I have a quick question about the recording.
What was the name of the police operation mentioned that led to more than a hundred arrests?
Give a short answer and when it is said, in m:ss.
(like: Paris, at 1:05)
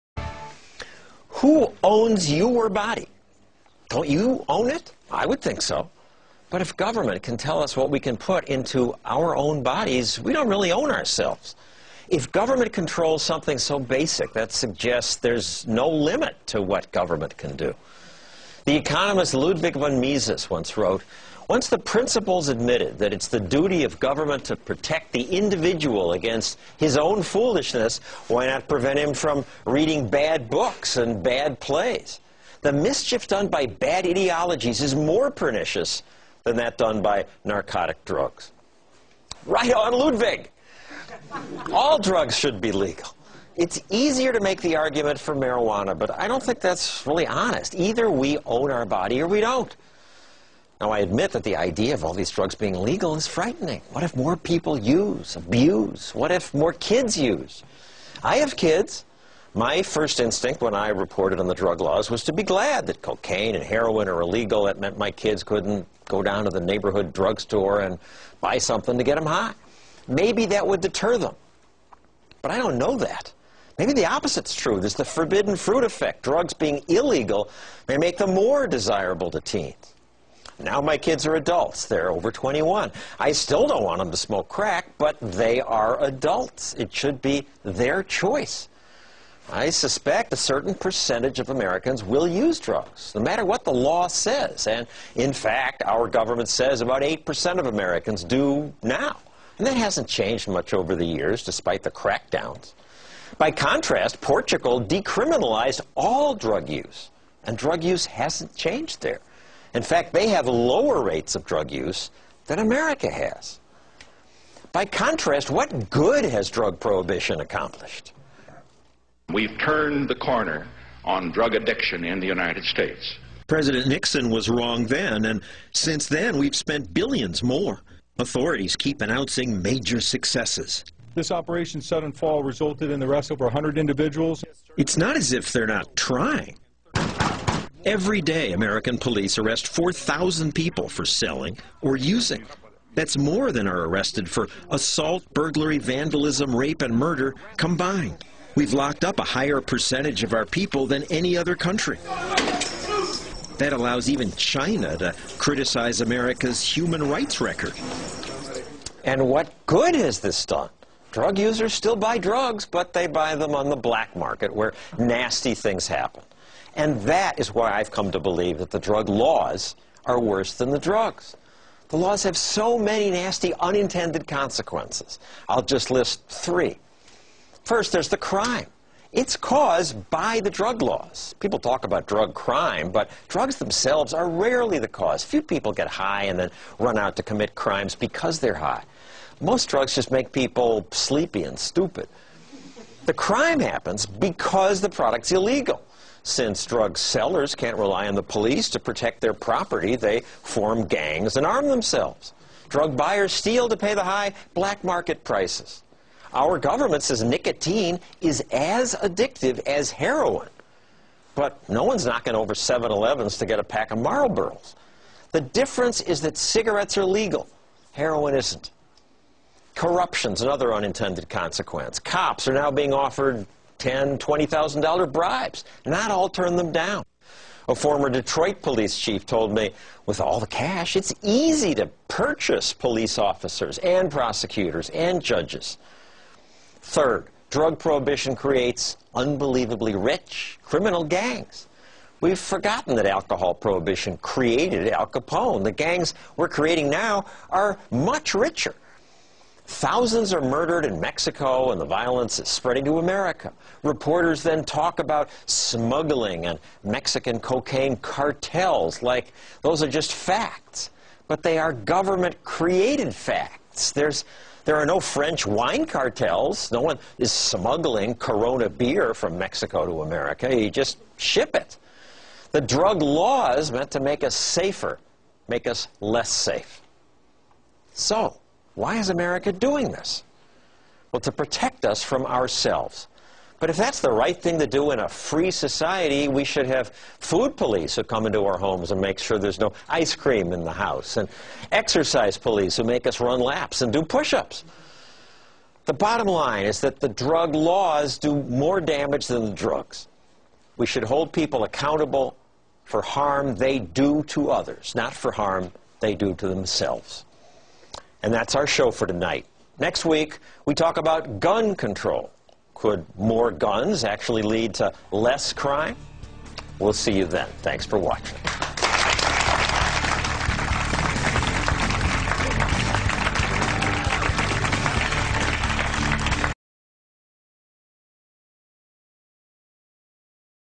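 Operation Sudden Fall, at 2:11.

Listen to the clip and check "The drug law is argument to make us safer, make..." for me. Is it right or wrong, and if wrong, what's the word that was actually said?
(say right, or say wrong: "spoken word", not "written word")
wrong: "meant", not "argument".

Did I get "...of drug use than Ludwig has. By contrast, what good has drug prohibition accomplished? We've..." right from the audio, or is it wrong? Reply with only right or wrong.
wrong.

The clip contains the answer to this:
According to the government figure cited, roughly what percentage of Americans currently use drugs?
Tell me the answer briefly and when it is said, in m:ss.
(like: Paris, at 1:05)
8%, at 1:37.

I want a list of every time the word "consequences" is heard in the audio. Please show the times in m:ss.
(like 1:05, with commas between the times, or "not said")
2:54, 3:41.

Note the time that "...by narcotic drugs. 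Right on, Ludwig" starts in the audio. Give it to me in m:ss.
0:37.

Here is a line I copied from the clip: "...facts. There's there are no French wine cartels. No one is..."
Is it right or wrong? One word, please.
right.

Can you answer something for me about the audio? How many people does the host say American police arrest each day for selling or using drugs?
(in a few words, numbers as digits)
4,000.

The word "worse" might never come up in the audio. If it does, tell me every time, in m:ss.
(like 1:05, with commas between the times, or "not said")
2:50.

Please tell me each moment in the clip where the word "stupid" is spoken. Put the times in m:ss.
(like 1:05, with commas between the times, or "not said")
3:11.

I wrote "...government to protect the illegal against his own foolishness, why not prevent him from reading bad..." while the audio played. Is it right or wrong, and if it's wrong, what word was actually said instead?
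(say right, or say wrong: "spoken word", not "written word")
wrong: "individual", not "illegal".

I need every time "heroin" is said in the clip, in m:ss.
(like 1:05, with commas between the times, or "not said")
1:03, 3:29, 3:37.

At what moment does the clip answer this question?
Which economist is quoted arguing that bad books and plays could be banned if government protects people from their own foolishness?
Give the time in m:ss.
0:19.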